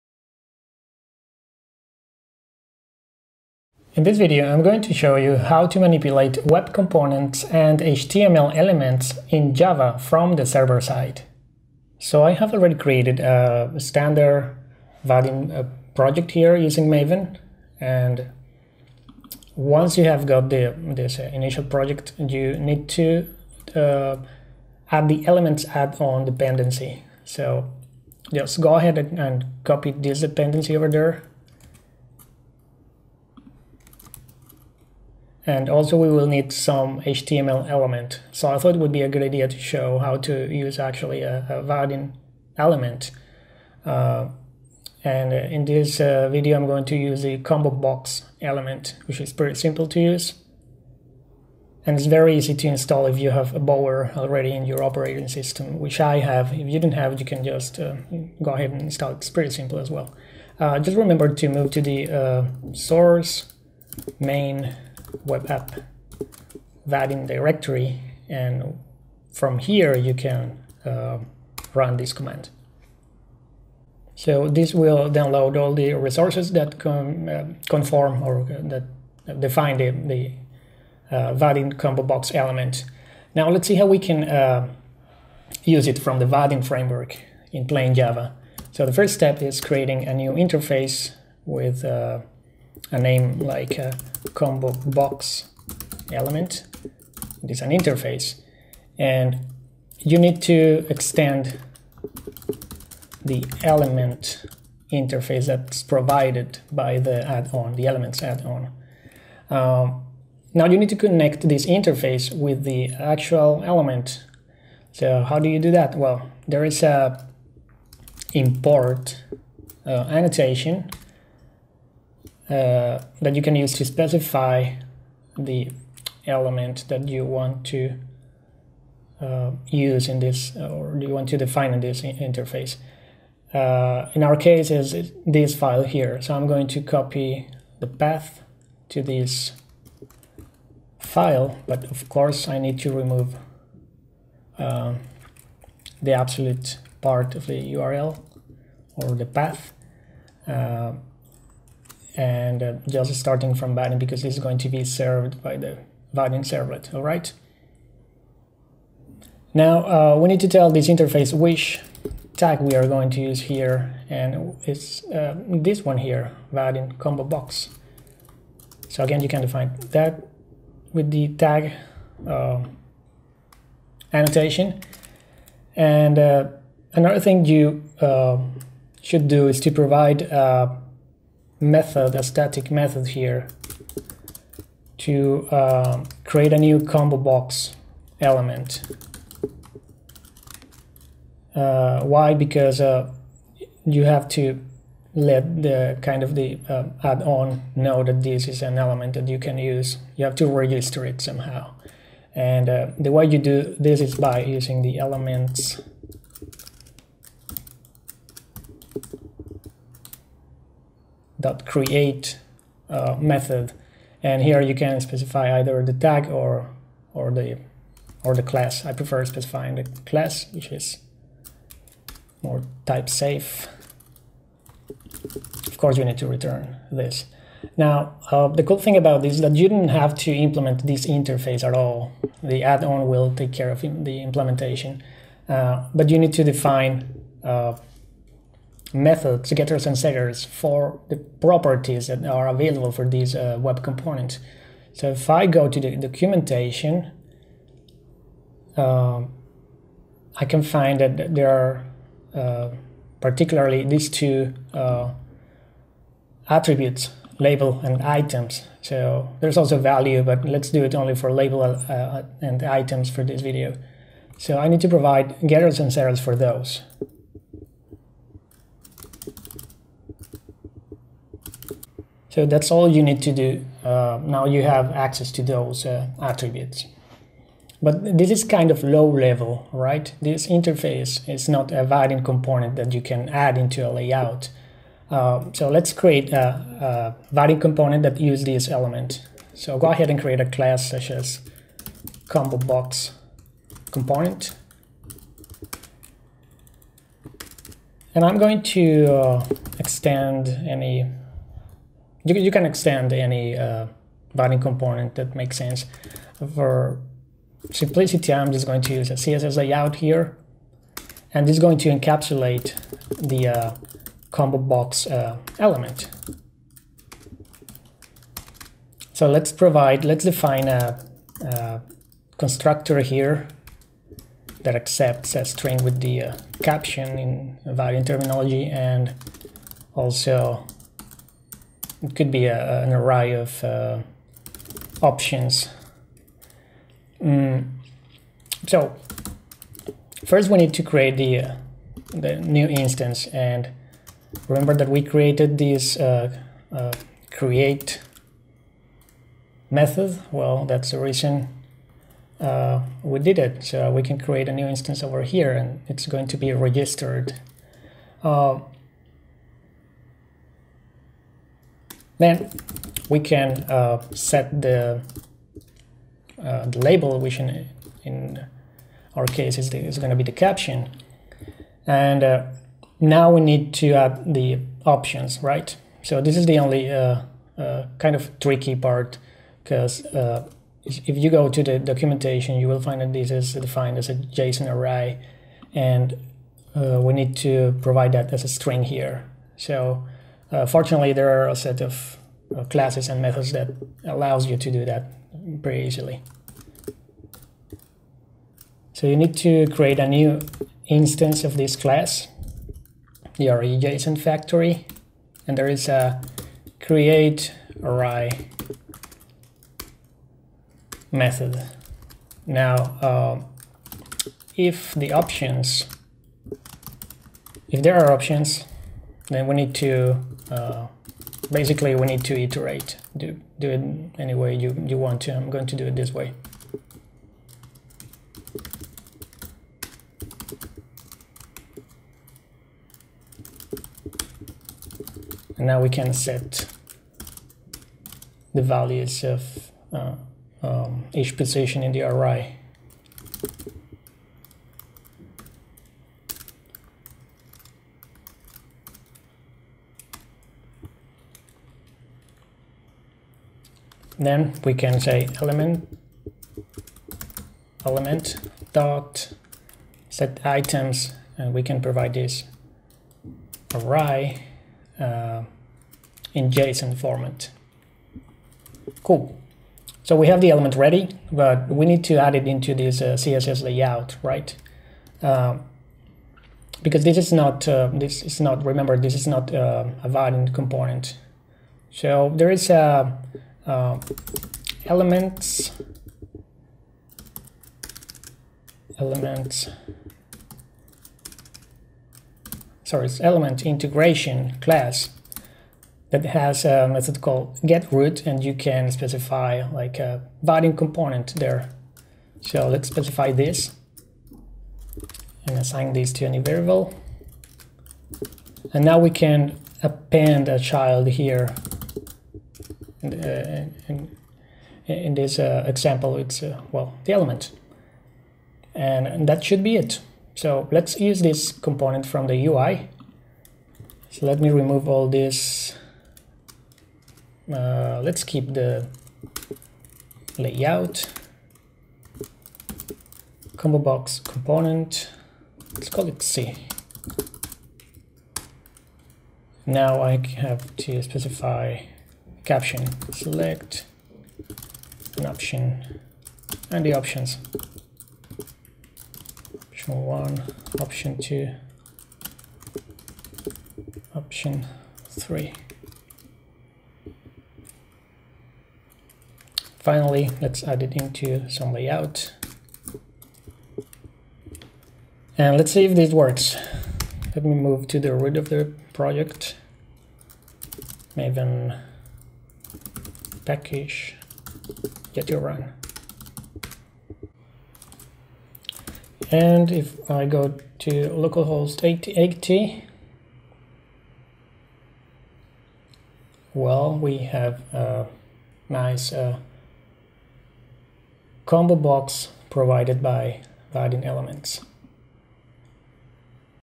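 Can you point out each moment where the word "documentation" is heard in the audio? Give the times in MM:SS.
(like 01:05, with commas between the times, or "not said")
04:05, 06:21.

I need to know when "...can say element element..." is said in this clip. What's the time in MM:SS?
07:34.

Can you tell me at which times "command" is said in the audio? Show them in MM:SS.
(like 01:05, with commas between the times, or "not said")
01:12.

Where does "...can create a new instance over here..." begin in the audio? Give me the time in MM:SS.
05:54.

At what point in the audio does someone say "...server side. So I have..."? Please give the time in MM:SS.
00:10.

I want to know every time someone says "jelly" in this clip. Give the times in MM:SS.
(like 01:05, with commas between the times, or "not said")
not said.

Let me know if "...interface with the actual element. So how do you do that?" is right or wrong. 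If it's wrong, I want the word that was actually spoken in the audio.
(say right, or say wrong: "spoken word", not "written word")
right.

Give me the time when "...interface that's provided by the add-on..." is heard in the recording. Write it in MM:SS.
01:44.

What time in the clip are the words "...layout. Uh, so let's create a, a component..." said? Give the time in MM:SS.
04:43.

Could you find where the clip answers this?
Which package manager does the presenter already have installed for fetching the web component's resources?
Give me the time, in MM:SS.
00:53.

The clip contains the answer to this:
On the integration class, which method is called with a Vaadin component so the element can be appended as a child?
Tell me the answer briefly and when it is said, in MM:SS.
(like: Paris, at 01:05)
get root, at 08:17.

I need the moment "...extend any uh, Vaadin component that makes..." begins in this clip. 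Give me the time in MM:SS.
05:02.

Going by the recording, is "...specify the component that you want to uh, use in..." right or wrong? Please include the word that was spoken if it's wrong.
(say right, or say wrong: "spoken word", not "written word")
wrong: "element", not "component".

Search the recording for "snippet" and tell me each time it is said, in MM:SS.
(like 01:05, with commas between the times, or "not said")
not said.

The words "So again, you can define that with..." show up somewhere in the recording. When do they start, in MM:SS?
02:48.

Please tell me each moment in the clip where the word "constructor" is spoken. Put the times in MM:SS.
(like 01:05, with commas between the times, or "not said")
05:22.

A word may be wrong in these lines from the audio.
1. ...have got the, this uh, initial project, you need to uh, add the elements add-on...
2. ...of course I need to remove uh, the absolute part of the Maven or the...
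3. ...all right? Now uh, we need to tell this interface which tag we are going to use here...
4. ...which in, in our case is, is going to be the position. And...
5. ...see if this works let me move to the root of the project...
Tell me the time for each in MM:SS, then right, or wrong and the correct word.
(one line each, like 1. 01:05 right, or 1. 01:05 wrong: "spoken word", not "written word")
1. 00:20 right
2. 02:21 wrong: "URL", not "Maven"
3. 02:36 right
4. 06:07 wrong: "caption", not "position"
5. 09:25 right.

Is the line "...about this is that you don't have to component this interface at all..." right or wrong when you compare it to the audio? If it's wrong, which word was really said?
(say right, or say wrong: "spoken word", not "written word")
wrong: "implement", not "component".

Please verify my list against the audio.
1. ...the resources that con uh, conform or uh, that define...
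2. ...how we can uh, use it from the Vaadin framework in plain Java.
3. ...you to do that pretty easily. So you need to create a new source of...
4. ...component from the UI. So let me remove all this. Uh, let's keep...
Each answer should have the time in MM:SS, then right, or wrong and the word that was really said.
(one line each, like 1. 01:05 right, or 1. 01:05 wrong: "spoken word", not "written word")
1. 01:15 right
2. 01:23 right
3. 06:34 wrong: "instance", not "source"
4. 08:41 right.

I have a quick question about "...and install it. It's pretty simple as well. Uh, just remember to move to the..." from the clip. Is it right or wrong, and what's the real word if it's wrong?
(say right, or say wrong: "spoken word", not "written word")
right.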